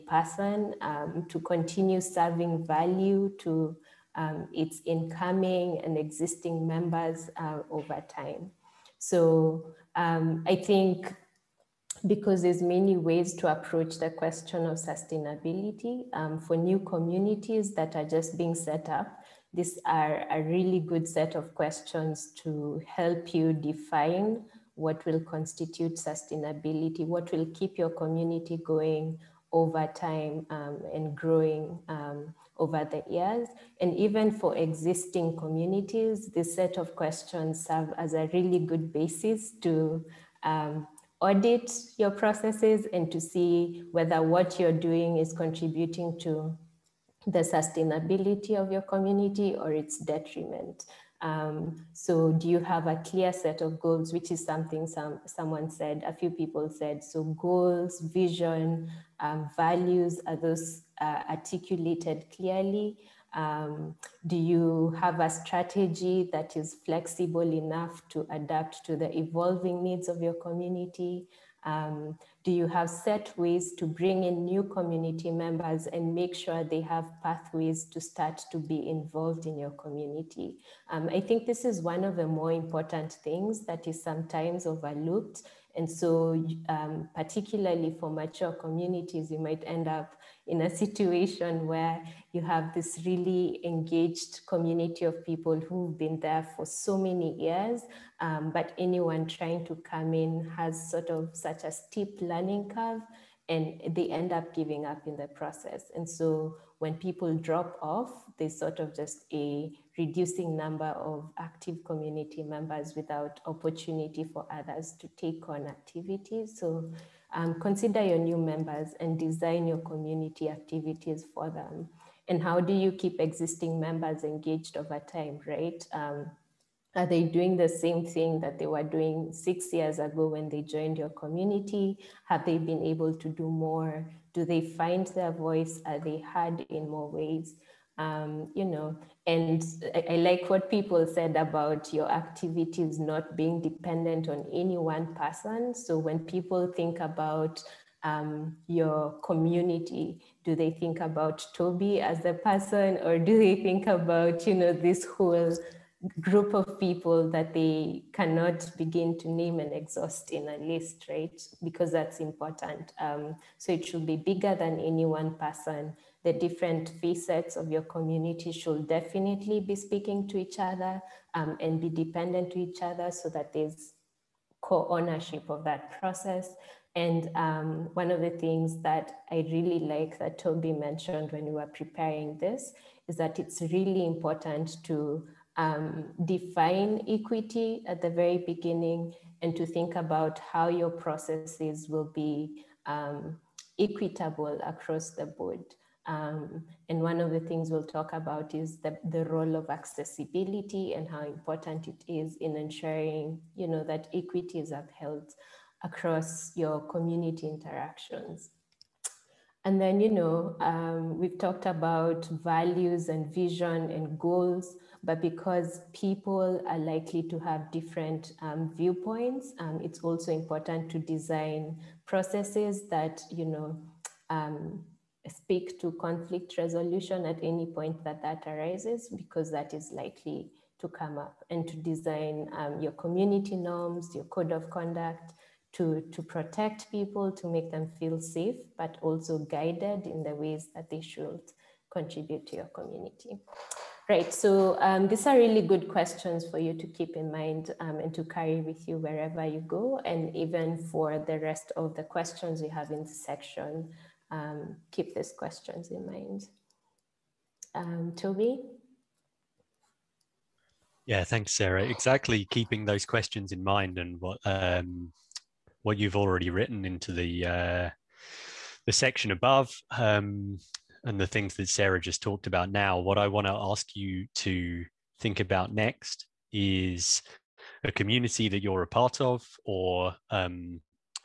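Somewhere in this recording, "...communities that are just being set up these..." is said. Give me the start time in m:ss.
0:16.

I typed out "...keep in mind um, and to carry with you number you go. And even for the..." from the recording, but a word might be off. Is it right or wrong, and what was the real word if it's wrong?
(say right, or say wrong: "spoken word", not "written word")
wrong: "wherever", not "number".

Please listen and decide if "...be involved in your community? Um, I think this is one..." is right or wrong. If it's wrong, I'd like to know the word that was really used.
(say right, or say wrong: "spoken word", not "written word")
right.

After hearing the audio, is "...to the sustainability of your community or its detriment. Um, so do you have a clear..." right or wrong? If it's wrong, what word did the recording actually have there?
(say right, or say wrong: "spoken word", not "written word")
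right.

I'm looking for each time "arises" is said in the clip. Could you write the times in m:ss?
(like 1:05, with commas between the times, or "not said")
3:48.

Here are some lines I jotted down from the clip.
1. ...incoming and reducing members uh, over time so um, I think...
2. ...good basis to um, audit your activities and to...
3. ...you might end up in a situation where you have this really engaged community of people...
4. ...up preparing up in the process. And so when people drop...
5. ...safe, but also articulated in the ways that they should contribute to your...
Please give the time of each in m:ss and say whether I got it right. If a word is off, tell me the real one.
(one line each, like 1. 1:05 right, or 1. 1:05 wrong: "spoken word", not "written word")
1. 0:04 wrong: "existing", not "reducing"
2. 0:38 wrong: "processes", not "activities"
3. 1:29 right
4. 1:44 wrong: "giving", not "preparing"
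5. 3:58 wrong: "guided", not "articulated".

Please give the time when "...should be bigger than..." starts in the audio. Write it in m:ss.
2:43.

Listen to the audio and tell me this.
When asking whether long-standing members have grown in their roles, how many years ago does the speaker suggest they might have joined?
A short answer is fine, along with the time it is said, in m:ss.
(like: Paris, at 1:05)
6, at 2:09.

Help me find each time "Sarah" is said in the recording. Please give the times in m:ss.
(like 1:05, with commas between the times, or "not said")
4:21, 4:31.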